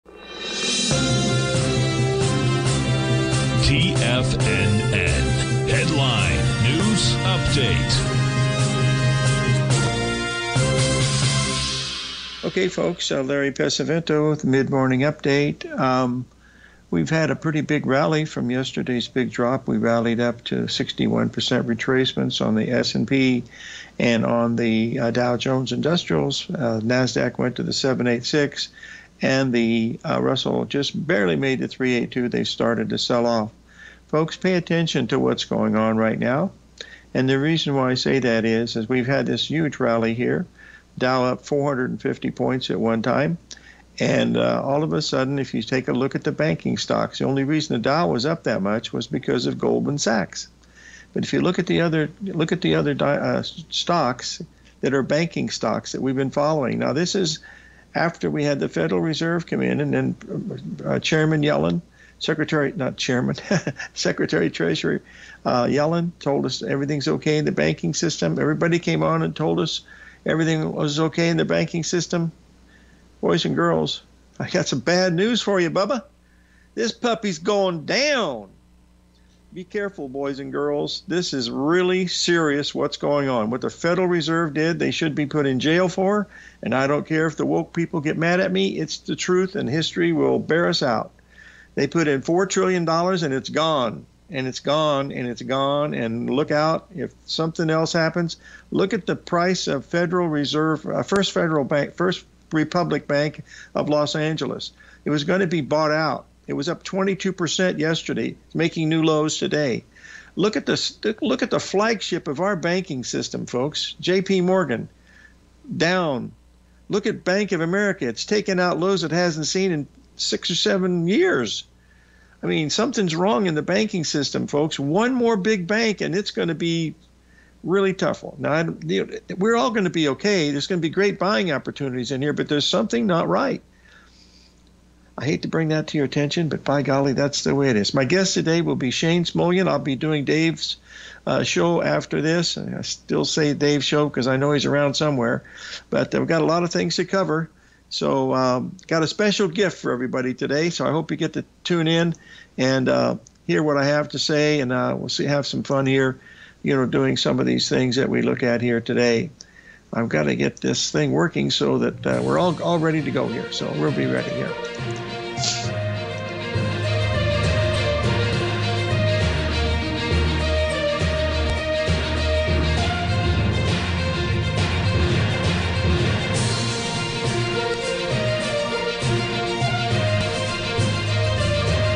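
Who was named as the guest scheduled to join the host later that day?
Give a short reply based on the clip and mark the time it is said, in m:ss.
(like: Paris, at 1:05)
Shane Smolian, at 2:18.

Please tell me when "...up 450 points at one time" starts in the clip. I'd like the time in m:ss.
0:41.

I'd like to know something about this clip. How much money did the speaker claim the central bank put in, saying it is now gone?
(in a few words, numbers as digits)
$4 trillion.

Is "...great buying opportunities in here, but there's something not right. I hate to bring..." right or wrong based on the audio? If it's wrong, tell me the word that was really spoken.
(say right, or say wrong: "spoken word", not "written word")
right.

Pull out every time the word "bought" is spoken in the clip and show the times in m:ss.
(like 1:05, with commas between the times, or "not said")
1:45.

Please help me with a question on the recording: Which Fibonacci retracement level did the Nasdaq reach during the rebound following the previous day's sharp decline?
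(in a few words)
786.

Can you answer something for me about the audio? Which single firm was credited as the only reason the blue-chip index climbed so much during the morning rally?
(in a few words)
Goldman Sachs.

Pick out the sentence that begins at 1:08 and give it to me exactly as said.
Everybody came on and told us everything was okay in the banking system.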